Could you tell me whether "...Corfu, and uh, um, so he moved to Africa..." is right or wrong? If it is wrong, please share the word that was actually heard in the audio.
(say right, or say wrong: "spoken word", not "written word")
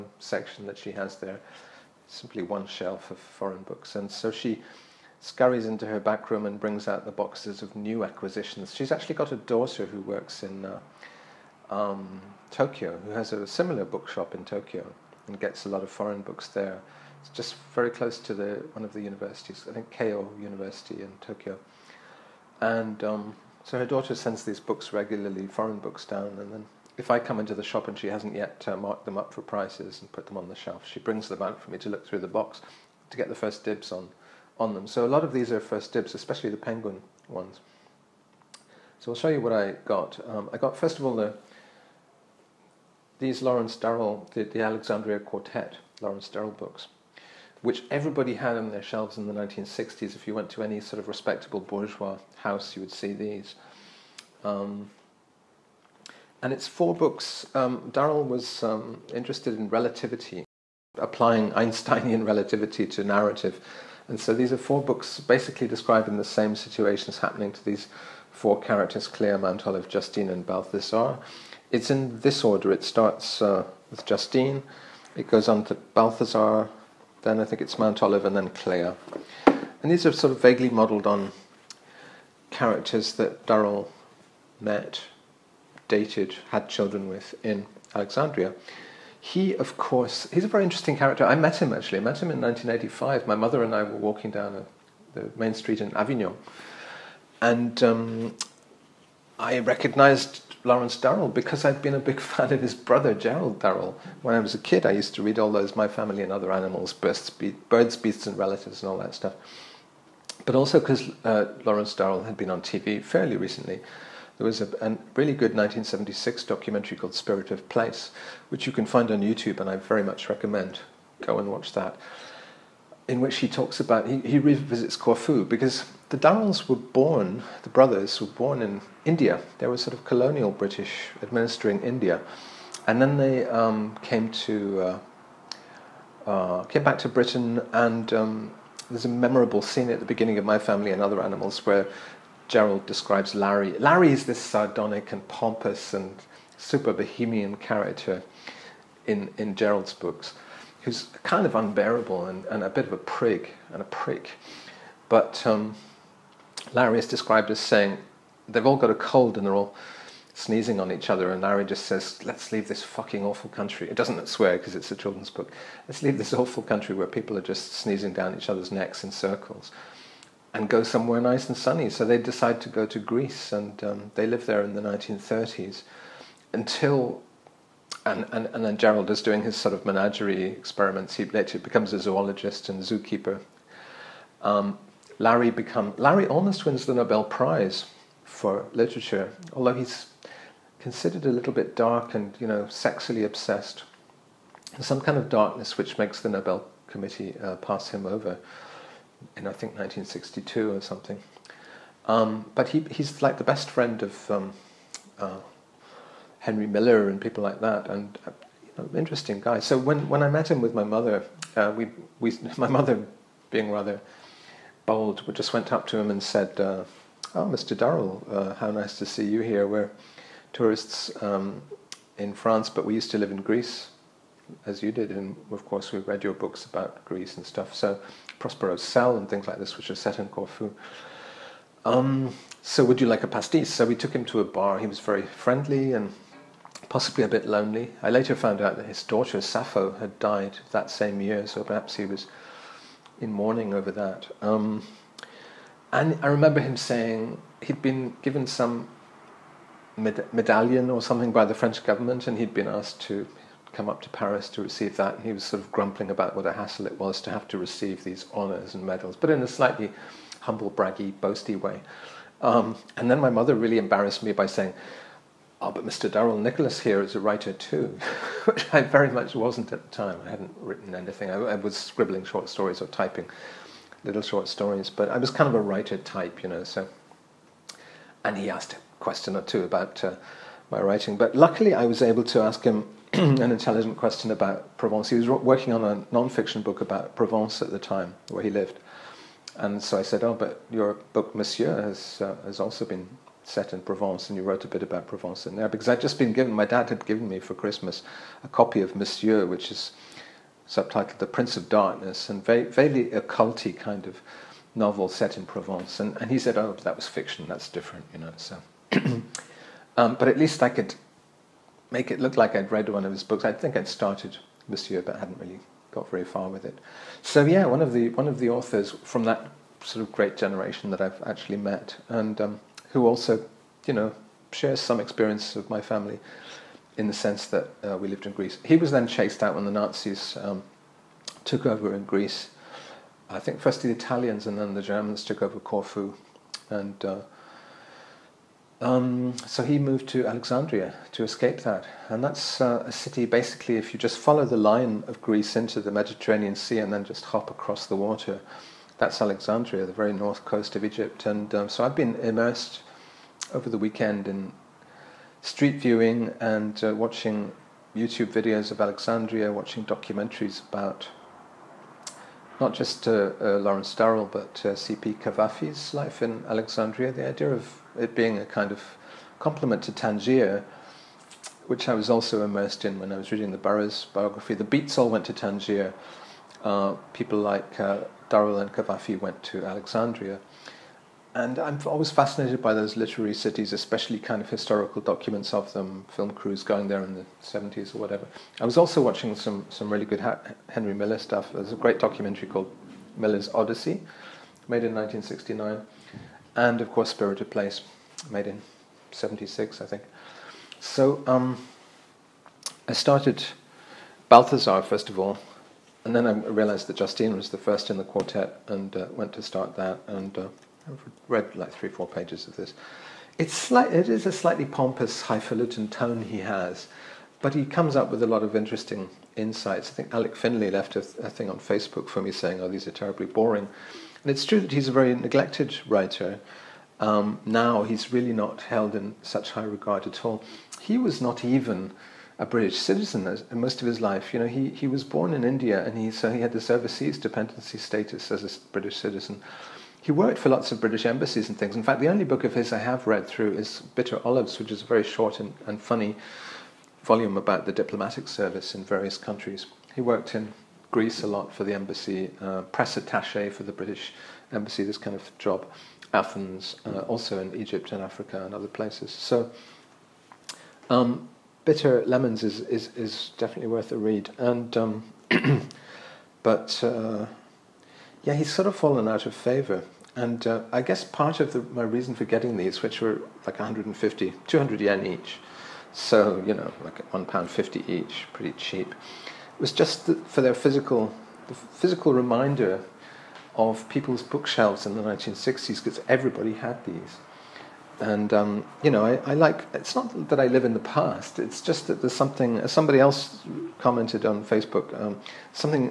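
wrong: "Alexandria", not "Africa".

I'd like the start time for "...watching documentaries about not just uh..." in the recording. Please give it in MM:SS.
05:59.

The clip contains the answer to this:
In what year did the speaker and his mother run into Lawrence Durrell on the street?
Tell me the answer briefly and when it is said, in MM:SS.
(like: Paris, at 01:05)
1985, at 01:32.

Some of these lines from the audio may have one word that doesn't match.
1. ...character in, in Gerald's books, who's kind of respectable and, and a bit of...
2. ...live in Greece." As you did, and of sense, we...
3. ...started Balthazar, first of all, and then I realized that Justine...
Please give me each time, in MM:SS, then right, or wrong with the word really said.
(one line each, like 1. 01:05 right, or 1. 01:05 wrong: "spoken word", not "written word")
1. 02:27 wrong: "unbearable", not "respectable"
2. 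03:43 wrong: "course", not "sense"
3. 06:42 right.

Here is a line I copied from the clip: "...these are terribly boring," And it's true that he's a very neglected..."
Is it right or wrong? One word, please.
right.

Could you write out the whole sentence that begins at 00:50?
If you went to any sort of respectable bourgeois house, you would see these.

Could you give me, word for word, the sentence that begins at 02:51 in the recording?
So they decide to go to Greece, and um, they live there in the 1930s until.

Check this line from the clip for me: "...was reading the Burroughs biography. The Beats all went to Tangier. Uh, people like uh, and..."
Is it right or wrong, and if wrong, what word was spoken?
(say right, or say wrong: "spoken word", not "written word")
right.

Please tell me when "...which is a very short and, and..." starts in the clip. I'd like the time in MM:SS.
07:24.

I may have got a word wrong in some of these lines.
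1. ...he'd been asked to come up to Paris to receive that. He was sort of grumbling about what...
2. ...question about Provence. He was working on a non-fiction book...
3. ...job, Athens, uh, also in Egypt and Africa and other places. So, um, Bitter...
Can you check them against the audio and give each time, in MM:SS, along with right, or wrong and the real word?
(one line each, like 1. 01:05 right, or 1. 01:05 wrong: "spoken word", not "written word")
1. 04:12 right
2. 04:43 right
3. 07:35 right.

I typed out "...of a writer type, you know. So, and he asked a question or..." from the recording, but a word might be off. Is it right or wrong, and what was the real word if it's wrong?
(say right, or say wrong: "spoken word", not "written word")
right.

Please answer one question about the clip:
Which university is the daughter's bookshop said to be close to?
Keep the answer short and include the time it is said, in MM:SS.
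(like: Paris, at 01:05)
Keio University, at 00:19.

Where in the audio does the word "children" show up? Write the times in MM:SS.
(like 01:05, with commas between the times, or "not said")
01:26, 02:44.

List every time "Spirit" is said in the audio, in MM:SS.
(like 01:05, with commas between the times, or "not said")
01:57, 06:37.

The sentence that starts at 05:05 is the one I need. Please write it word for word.
And and he said, "Oh, that was fiction.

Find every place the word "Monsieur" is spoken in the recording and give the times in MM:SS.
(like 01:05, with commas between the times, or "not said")
04:51, 04:58.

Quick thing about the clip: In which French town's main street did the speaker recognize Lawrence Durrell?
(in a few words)
Avignon.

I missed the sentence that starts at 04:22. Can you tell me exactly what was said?
Um, and then my mother really embarrassed me by saying, Oh, but Mr.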